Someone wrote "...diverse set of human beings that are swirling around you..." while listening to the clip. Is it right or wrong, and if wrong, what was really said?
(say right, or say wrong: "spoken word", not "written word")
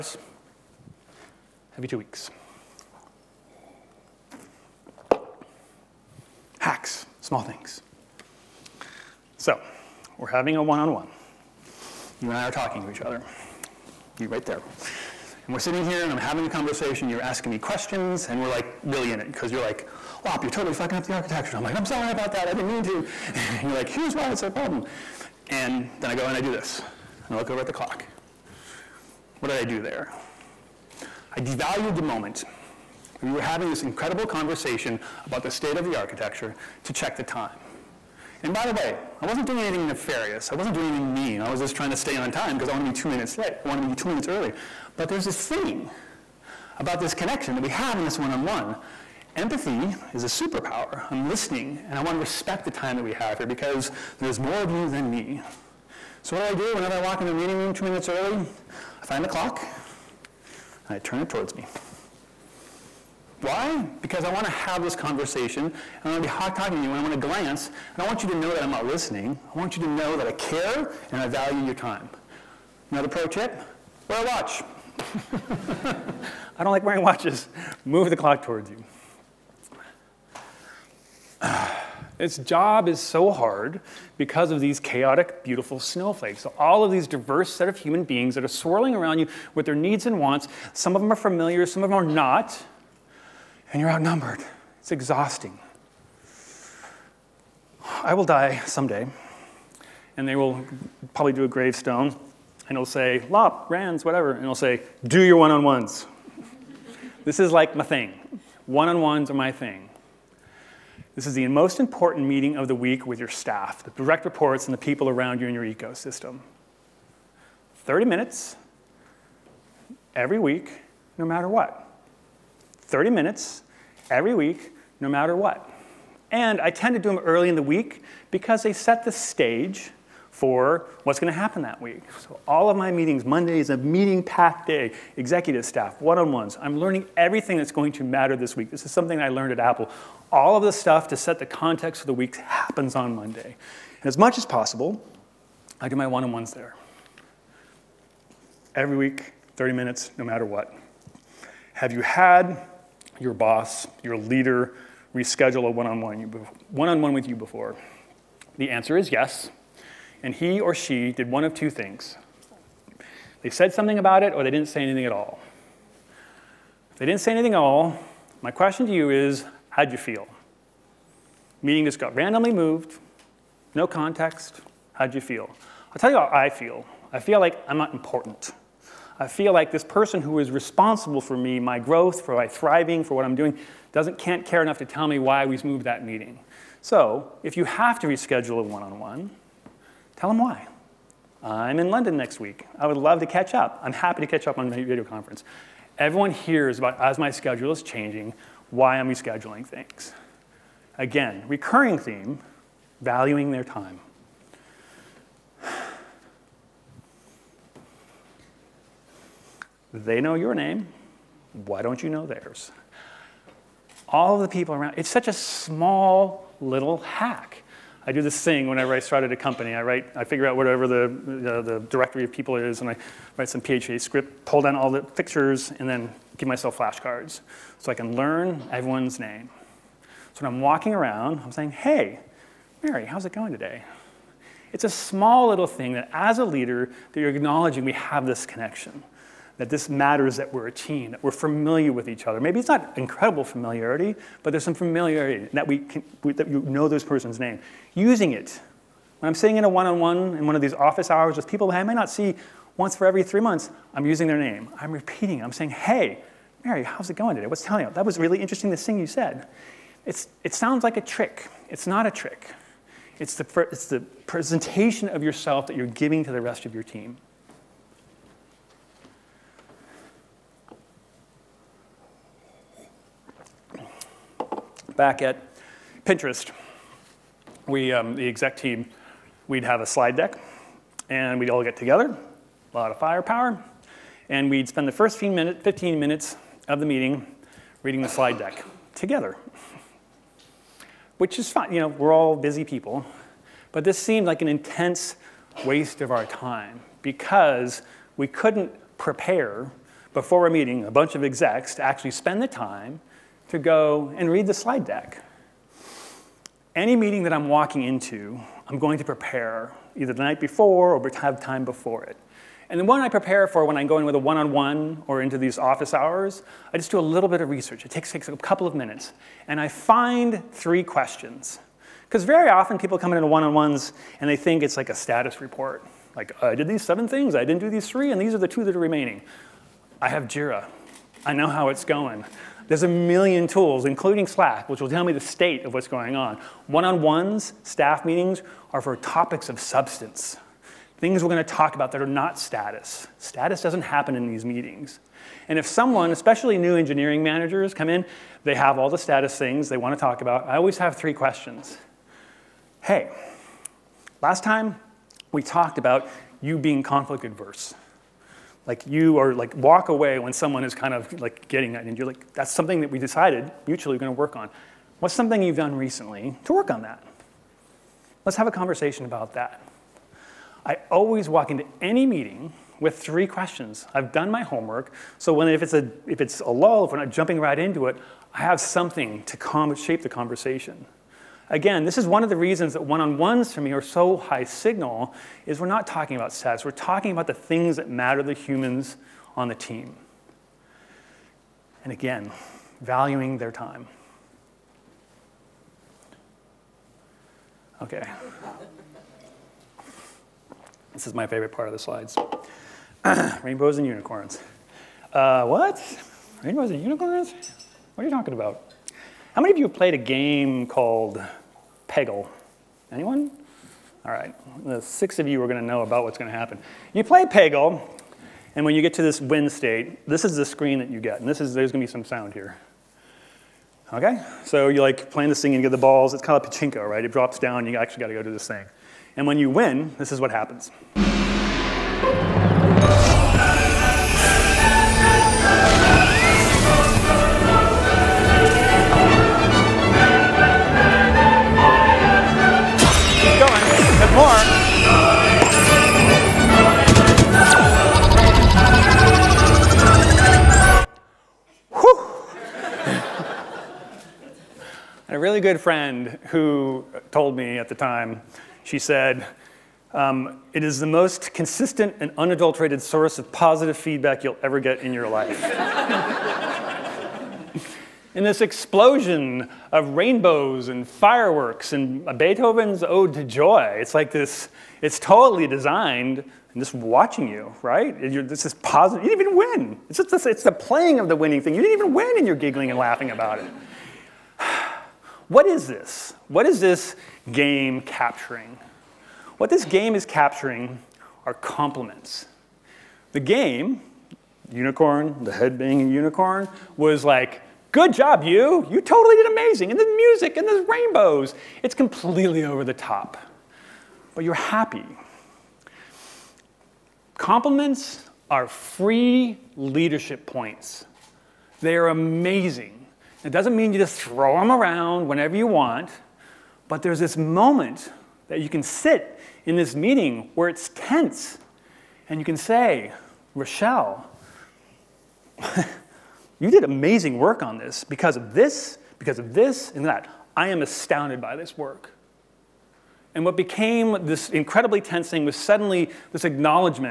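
right.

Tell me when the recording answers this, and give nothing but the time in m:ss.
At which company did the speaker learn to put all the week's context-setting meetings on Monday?
2:18.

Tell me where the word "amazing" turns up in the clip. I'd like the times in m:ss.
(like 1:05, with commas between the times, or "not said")
8:19, 8:31, 8:46.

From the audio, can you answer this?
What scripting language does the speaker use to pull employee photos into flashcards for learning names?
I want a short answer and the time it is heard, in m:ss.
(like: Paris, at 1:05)
PHP, at 3:43.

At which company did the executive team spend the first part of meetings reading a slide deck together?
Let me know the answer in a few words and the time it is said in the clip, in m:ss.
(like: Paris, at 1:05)
Pinterest, at 4:34.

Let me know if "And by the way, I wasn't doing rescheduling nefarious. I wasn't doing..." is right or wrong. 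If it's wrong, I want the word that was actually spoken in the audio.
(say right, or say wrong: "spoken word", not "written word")
wrong: "anything", not "rescheduling".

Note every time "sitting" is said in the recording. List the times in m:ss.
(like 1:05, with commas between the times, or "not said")
0:15, 4:09.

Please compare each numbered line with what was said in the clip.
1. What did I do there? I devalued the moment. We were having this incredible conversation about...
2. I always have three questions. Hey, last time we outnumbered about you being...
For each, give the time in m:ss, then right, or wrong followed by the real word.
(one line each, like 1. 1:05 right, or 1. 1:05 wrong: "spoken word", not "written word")
1. 0:29 right
2. 5:50 wrong: "talked", not "outnumbered".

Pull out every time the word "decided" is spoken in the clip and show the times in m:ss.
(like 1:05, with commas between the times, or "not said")
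6:02.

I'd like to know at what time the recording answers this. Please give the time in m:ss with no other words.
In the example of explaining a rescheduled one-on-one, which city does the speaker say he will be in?
3:11.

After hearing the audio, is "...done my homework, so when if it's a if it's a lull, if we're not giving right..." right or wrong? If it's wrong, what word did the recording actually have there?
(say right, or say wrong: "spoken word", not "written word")
wrong: "jumping", not "giving".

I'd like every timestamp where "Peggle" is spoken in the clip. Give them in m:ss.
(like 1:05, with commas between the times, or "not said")
6:51, 6:57.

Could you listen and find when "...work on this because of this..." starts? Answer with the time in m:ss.
8:47.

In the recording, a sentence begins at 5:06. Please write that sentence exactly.
Any meeting that I'm walking into, I'm going to prepare either the night before or have time before it.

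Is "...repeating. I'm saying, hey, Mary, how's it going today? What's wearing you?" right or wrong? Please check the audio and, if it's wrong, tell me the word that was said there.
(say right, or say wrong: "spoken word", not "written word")
wrong: "telling", not "wearing".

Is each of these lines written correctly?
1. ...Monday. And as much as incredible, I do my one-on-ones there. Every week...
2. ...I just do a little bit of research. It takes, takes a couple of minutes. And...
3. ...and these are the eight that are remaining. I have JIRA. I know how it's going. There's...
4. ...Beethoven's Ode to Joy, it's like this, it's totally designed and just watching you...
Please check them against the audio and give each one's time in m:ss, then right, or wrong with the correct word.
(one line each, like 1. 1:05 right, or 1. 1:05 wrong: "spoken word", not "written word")
1. 2:23 wrong: "possible", not "incredible"
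2. 5:16 right
3. 5:28 wrong: "two", not "eight"
4. 7:52 right.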